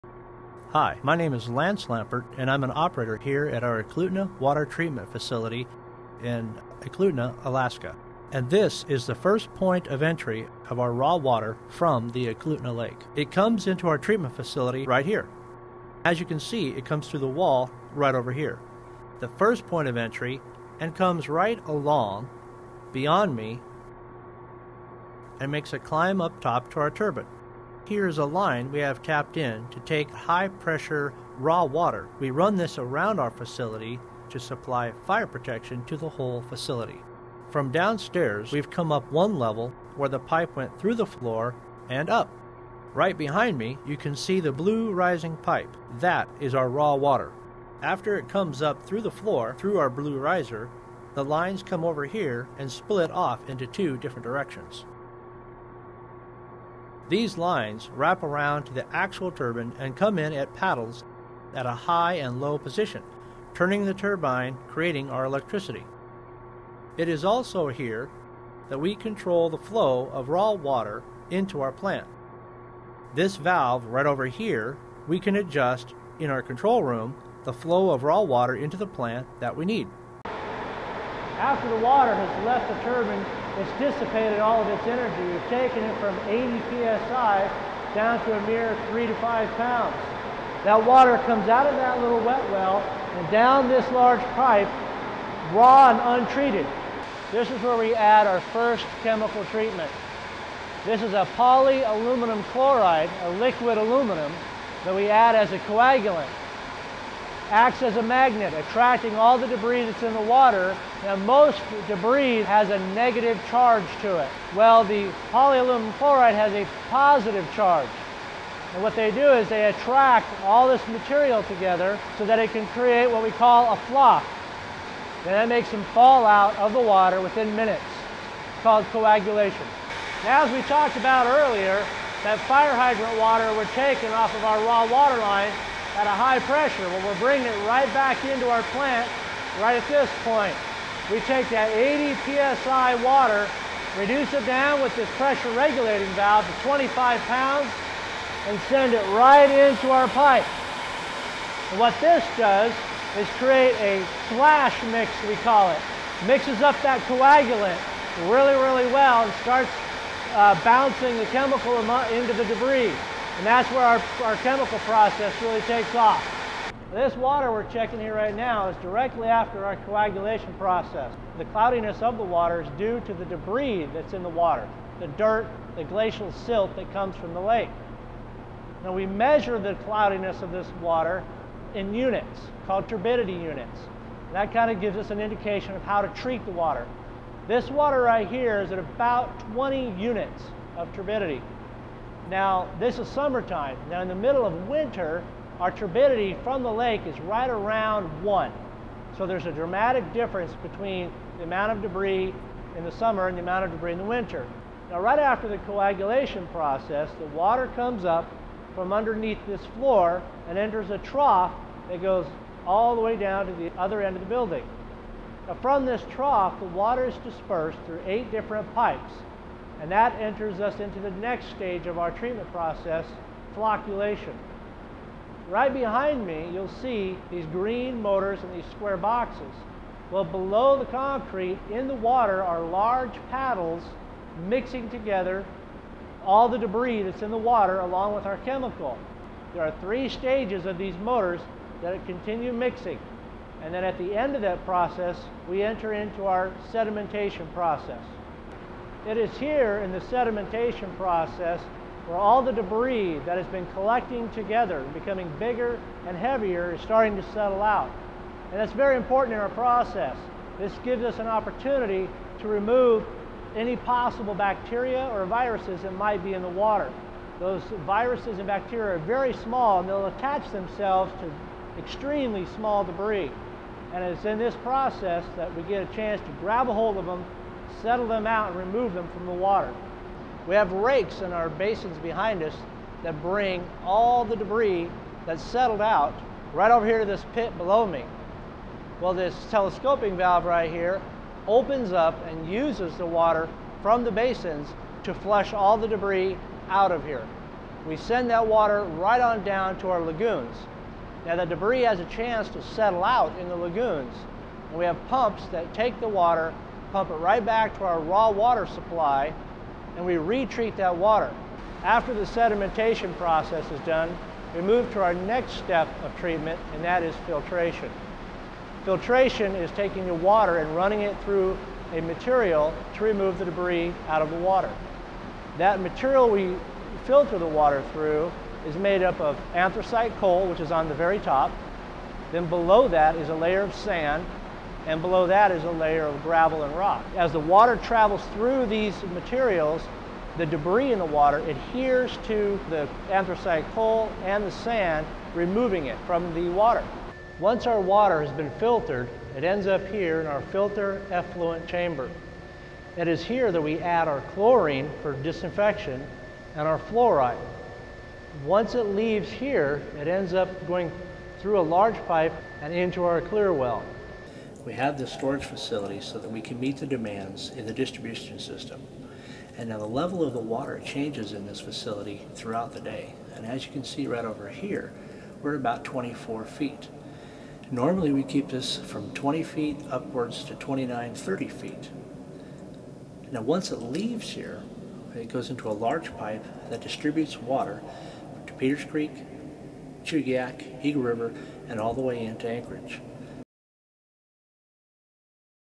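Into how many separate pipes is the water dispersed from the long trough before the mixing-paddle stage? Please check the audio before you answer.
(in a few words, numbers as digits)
8.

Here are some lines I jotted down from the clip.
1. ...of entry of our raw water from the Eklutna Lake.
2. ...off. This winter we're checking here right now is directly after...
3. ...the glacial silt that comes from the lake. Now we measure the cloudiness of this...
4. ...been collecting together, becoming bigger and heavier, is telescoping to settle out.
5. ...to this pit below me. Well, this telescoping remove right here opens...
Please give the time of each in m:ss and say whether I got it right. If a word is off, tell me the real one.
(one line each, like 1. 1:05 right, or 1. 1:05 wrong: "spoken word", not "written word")
1. 0:09 right
2. 2:45 wrong: "water", not "winter"
3. 2:55 right
4. 4:13 wrong: "starting", not "telescoping"
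5. 4:46 wrong: "valve", not "remove".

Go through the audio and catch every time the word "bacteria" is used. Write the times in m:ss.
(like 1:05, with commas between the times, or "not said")
4:24, 4:28.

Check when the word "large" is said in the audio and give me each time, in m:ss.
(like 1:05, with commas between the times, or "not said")
1:33, 3:52, 6:01, 6:25.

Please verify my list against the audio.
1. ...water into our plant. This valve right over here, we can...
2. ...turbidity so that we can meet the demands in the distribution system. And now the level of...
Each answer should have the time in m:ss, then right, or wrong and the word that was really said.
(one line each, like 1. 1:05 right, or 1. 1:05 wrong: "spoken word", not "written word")
1. 1:10 right
2. 6:05 wrong: "facility", not "turbidity".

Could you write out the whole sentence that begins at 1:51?
Now most debris has a negative charge to it.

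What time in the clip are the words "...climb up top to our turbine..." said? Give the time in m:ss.
0:25.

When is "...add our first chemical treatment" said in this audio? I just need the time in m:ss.
1:37.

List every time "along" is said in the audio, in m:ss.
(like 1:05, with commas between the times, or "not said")
0:21, 3:57.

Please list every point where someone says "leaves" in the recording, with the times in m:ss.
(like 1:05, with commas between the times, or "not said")
5:58, 6:23.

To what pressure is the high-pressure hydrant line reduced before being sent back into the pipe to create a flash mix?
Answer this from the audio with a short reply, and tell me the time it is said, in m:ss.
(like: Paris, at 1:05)
25 pounds, at 2:26.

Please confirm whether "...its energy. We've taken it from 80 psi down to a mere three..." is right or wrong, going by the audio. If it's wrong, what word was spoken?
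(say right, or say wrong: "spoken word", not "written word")
right.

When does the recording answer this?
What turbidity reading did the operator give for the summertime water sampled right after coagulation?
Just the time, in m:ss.
3:09.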